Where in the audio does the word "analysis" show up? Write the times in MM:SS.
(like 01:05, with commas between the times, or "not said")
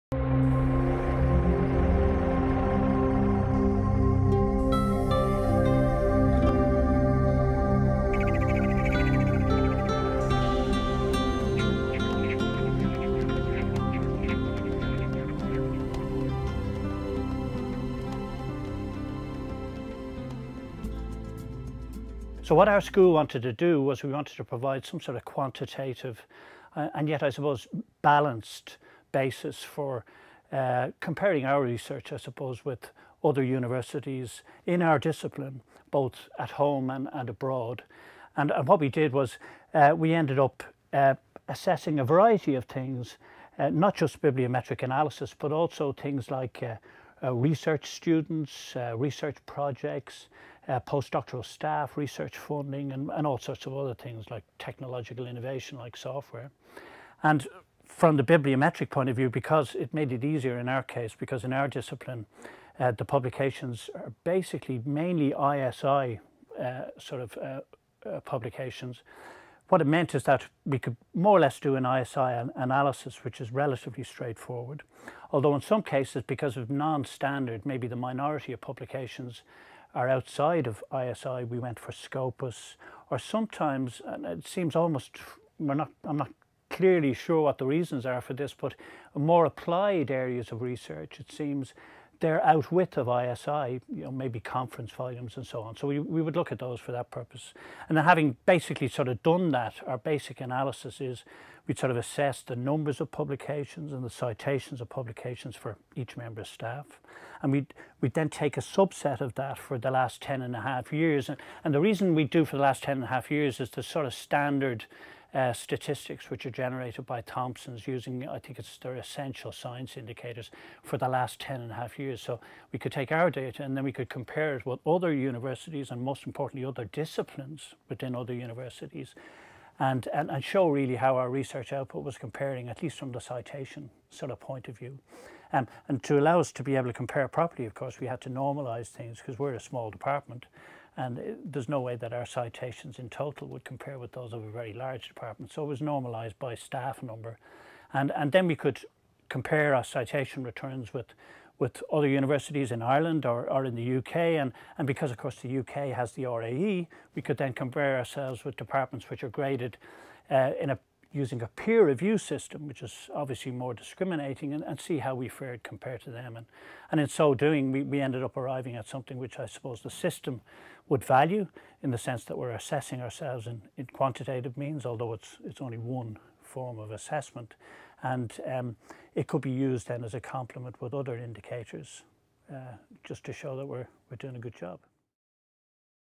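00:44, 01:12, 01:40.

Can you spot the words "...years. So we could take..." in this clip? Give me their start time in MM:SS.
02:01.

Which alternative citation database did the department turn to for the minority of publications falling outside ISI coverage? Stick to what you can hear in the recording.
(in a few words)
Scopus.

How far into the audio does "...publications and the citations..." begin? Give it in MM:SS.
01:43.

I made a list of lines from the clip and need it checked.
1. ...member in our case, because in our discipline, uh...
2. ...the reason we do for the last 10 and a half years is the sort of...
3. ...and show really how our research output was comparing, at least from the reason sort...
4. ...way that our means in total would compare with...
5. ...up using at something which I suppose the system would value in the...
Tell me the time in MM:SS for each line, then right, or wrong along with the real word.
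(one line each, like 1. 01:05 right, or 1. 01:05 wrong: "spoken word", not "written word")
1. 01:00 wrong: "easier", not "member"
2. 01:51 right
3. 02:10 wrong: "citation", not "reason"
4. 02:21 wrong: "citations", not "means"
5. 02:48 wrong: "arriving", not "using".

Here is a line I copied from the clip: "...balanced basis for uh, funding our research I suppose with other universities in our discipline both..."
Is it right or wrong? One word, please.
wrong.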